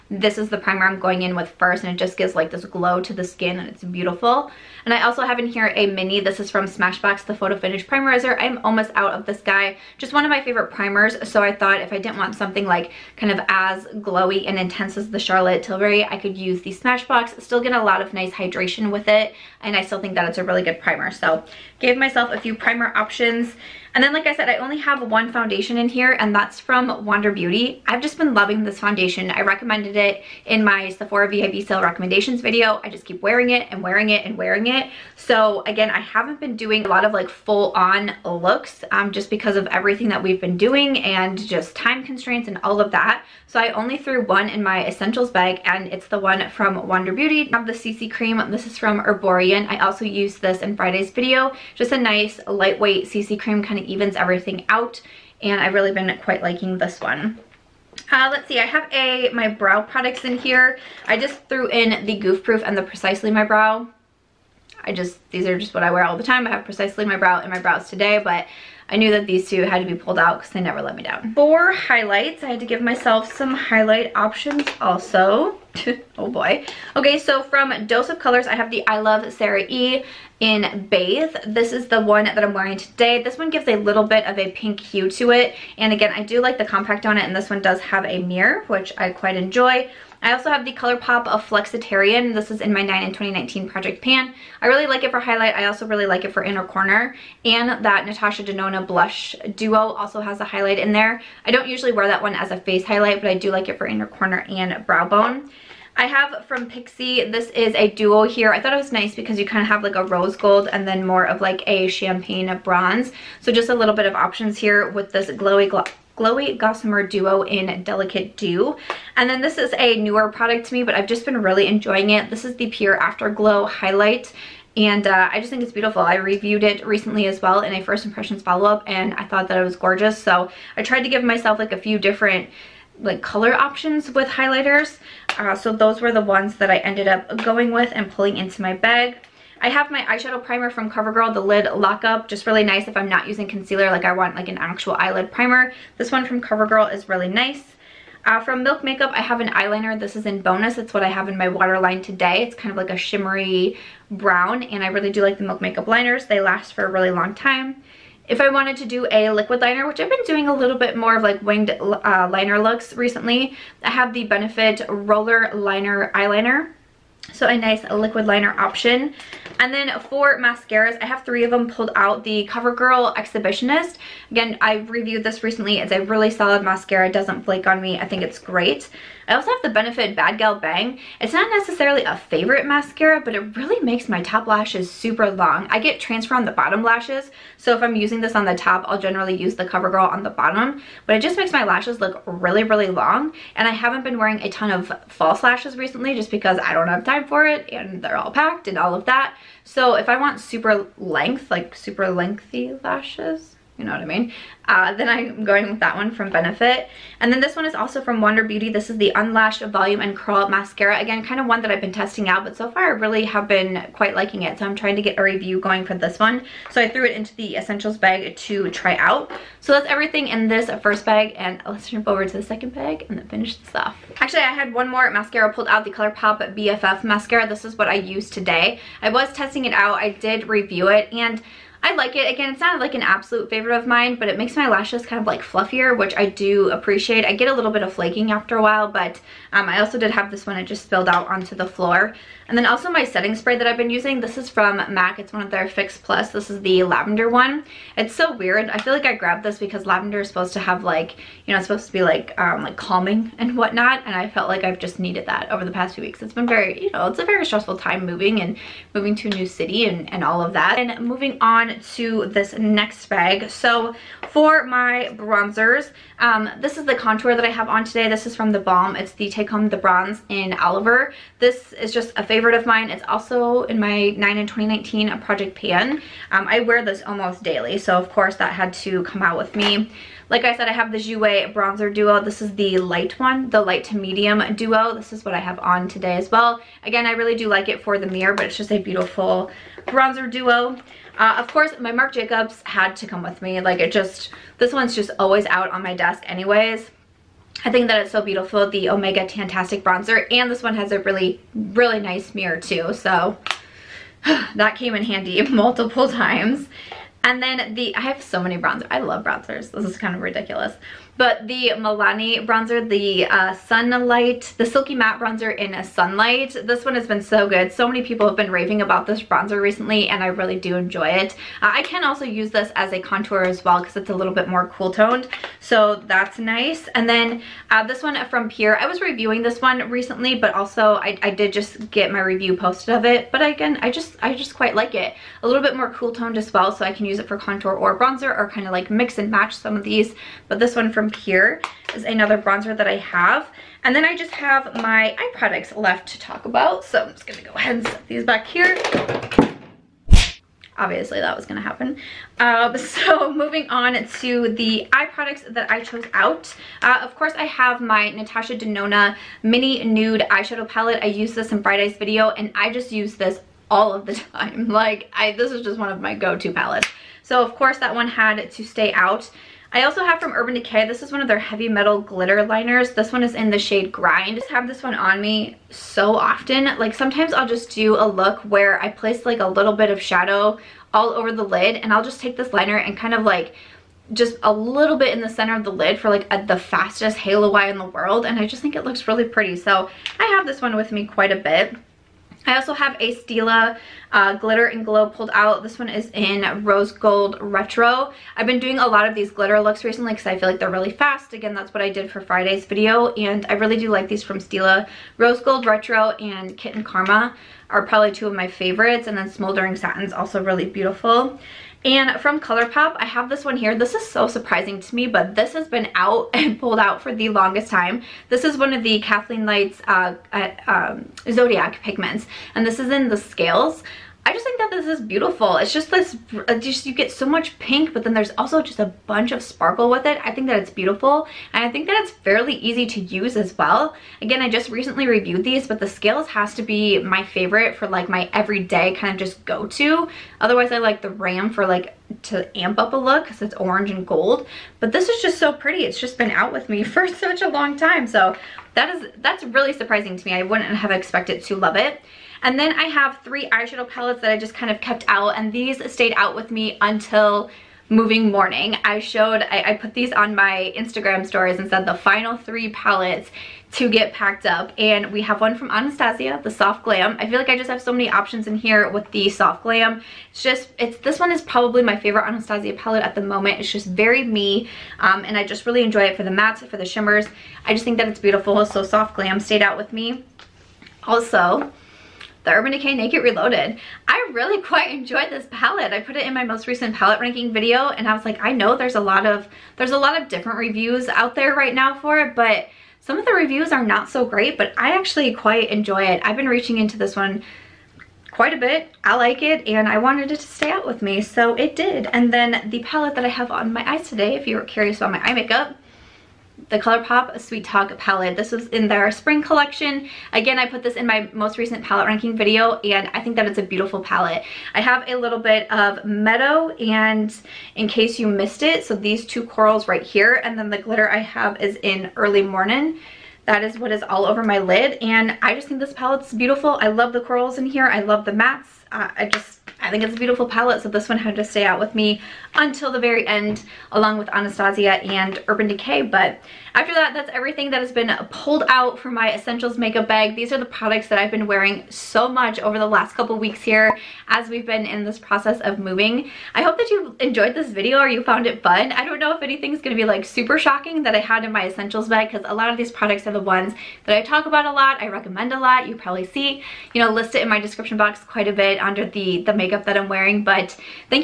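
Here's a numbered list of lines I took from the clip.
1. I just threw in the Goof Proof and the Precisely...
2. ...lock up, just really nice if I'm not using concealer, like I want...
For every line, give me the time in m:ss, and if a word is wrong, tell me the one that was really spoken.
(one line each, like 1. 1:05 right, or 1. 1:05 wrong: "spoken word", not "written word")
1. 1:01 right
2. 2:21 right.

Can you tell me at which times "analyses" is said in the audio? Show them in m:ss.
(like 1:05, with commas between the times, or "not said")
not said.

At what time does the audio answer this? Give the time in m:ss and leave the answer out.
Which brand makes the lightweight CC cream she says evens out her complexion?
0:48.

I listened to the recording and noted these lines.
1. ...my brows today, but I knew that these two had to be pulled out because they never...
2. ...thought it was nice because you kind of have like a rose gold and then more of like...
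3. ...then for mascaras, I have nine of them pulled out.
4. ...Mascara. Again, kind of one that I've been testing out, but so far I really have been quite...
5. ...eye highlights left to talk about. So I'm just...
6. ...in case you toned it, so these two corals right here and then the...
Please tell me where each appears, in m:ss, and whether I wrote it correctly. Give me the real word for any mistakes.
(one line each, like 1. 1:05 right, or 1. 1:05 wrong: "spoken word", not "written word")
1. 1:07 right
2. 1:48 right
3. 2:49 wrong: "three", not "nine"
4. 3:30 right
5. 5:45 wrong: "products", not "highlights"
6. 8:37 wrong: "missed", not "toned".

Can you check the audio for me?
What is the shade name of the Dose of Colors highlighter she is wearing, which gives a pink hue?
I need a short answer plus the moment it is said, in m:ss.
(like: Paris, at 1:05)
Bathe, at 1:20.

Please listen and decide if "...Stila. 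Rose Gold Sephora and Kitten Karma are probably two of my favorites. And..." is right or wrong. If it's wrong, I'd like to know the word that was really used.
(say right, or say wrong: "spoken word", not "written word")
wrong: "Retro", not "Sephora".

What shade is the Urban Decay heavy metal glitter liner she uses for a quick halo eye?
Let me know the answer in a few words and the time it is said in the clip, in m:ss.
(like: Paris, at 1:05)
Grind, at 6:13.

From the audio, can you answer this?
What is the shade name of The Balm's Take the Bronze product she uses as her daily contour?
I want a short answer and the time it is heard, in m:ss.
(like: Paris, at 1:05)
Oliver, at 4:30.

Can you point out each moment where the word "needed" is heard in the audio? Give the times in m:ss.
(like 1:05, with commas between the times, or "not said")
4:14.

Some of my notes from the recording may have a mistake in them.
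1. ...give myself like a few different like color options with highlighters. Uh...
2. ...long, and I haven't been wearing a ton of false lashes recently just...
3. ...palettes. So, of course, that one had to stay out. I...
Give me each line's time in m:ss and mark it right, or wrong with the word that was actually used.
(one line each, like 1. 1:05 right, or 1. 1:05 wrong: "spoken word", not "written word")
1. 2:11 right
2. 3:12 right
3. 6:06 right.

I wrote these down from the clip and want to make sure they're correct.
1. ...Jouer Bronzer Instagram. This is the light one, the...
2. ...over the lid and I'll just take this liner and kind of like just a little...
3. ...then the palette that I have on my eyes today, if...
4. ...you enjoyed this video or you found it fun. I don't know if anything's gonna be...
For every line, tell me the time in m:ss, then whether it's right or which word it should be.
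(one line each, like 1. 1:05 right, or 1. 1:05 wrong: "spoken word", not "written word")
1. 4:40 wrong: "Duo", not "Instagram"
2. 6:21 right
3. 8:22 right
4. 9:06 right.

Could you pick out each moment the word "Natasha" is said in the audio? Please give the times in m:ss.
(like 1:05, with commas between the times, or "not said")
1:38, 5:58.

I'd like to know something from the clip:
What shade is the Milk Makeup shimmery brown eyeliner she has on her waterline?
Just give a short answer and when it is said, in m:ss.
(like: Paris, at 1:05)
Bonus, at 2:30.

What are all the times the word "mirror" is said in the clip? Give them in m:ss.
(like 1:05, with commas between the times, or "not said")
1:28, 4:48, 5:02.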